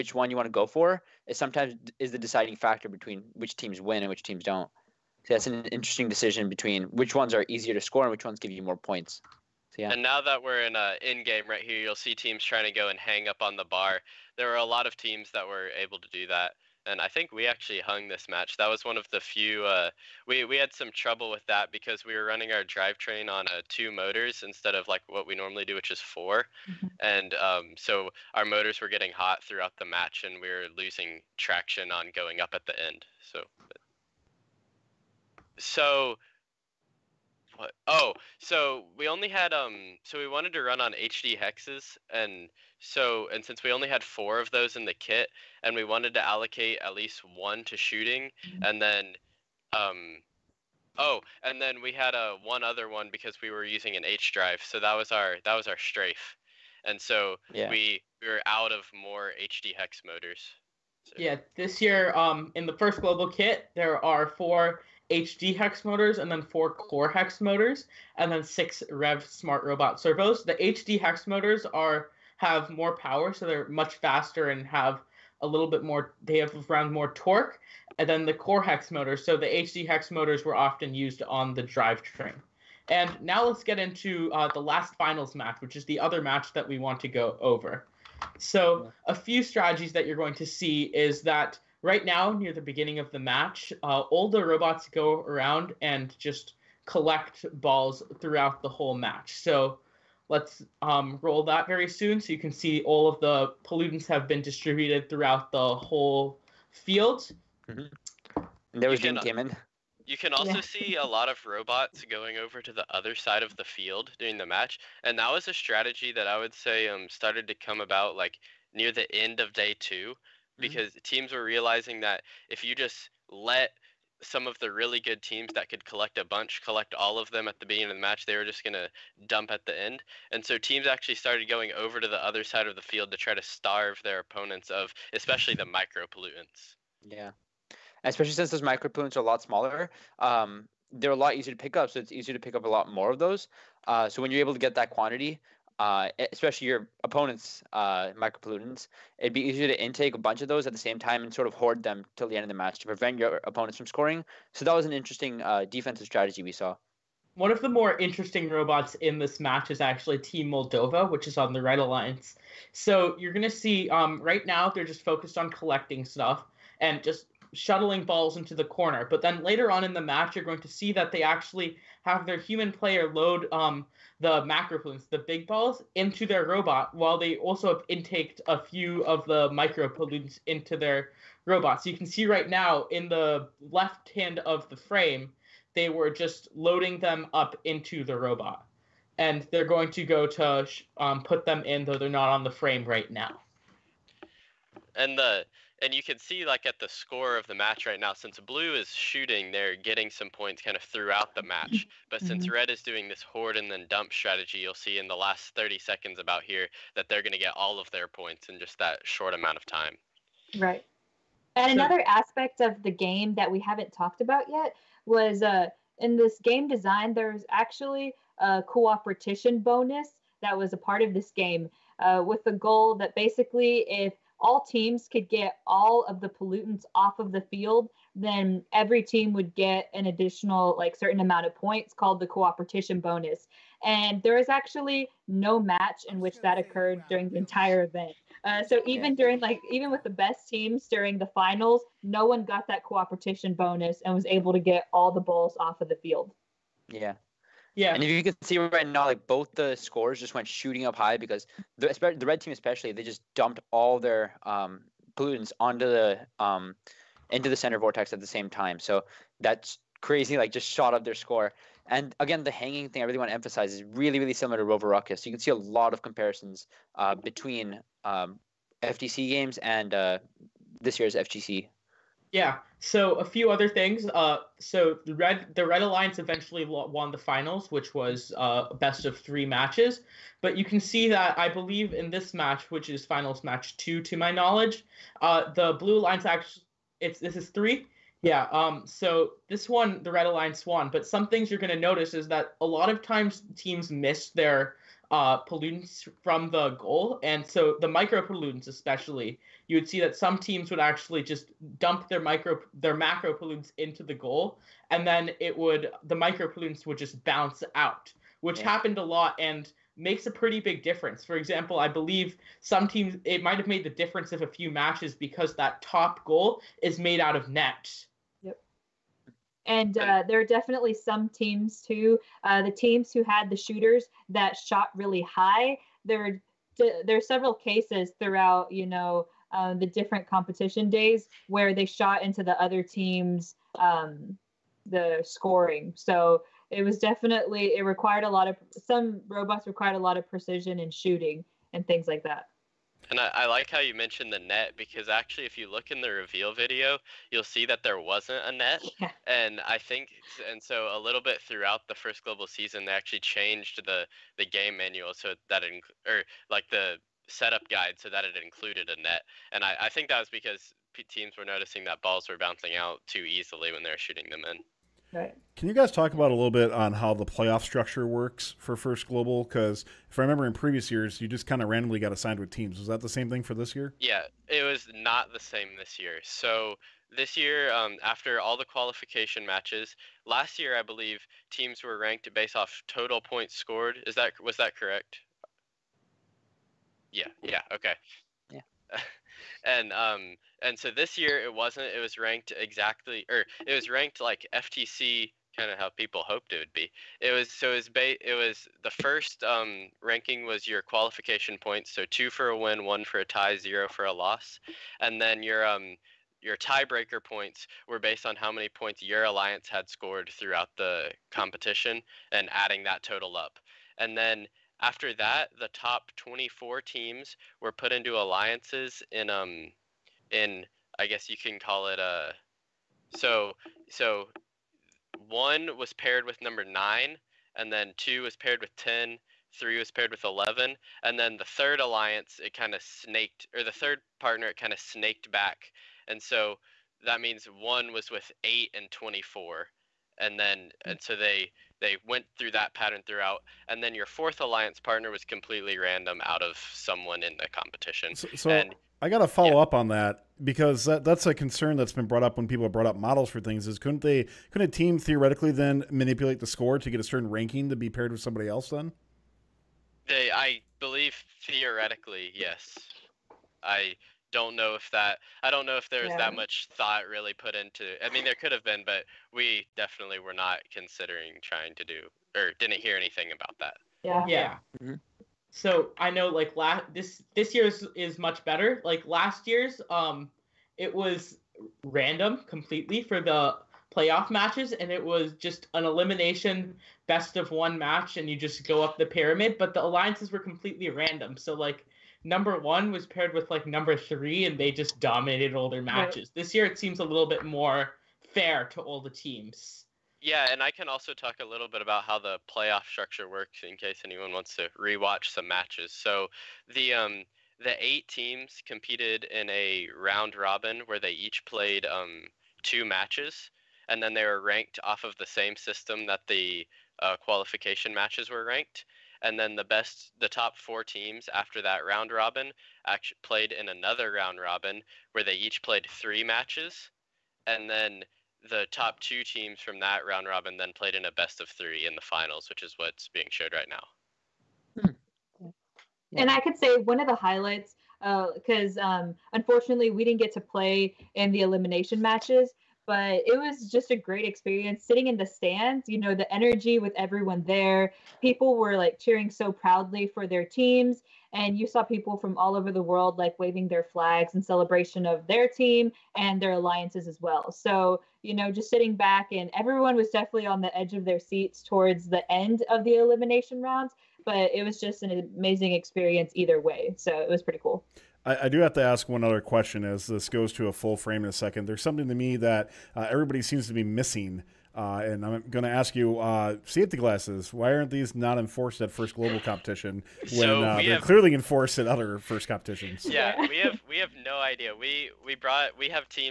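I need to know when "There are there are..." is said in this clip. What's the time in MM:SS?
05:26.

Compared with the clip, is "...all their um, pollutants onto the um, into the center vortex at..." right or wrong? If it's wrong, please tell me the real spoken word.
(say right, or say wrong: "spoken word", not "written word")
right.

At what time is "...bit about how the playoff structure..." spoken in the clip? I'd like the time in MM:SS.
08:21.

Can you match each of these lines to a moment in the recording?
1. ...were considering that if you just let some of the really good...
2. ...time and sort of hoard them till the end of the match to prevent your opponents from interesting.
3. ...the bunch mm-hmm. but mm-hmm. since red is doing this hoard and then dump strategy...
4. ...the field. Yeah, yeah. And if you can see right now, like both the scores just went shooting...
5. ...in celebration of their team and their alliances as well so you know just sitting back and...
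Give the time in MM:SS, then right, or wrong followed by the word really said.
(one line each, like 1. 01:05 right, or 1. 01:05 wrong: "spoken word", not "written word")
1. 02:01 wrong: "realizing", not "considering"
2. 02:30 wrong: "scoring", not "interesting"
3. 03:21 wrong: "match", not "bunch"
4. 04:05 right
5. 09:14 right.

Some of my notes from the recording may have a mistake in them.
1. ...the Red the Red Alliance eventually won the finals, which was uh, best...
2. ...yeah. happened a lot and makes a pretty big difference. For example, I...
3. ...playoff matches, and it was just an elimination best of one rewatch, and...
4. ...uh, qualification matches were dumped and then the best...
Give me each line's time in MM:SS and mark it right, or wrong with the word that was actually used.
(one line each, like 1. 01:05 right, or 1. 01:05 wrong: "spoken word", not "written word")
1. 04:35 right
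2. 05:08 right
3. 08:03 wrong: "match", not "rewatch"
4. 08:36 wrong: "ranked", not "dumped".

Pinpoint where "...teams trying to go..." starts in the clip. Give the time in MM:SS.
00:12.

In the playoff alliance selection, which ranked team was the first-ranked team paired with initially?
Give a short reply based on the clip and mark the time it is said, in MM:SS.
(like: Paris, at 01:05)
9, at 07:06.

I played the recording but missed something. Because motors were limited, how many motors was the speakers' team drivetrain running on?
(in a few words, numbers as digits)
2.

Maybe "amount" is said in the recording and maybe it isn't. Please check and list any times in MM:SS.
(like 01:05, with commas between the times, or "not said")
03:29, 03:51.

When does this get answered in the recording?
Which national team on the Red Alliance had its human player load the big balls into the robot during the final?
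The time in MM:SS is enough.
02:40.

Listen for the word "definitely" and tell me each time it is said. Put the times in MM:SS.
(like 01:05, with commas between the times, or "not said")
05:20, 05:36, 07:49, 09:20.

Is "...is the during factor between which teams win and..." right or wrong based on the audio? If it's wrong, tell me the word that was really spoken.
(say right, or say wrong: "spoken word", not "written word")
wrong: "deciding", not "during".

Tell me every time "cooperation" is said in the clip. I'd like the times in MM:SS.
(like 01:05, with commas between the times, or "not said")
03:38, 03:52, 04:02.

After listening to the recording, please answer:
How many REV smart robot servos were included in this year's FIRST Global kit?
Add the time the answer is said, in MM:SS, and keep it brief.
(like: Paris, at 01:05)
6, at 01:08.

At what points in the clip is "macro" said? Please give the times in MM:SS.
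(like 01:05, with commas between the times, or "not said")
02:54, 05:02.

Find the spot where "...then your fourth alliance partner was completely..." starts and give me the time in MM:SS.
07:23.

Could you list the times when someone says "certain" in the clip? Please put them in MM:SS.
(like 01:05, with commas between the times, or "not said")
03:50, 07:37.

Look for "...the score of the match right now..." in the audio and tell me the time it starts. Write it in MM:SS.
03:16.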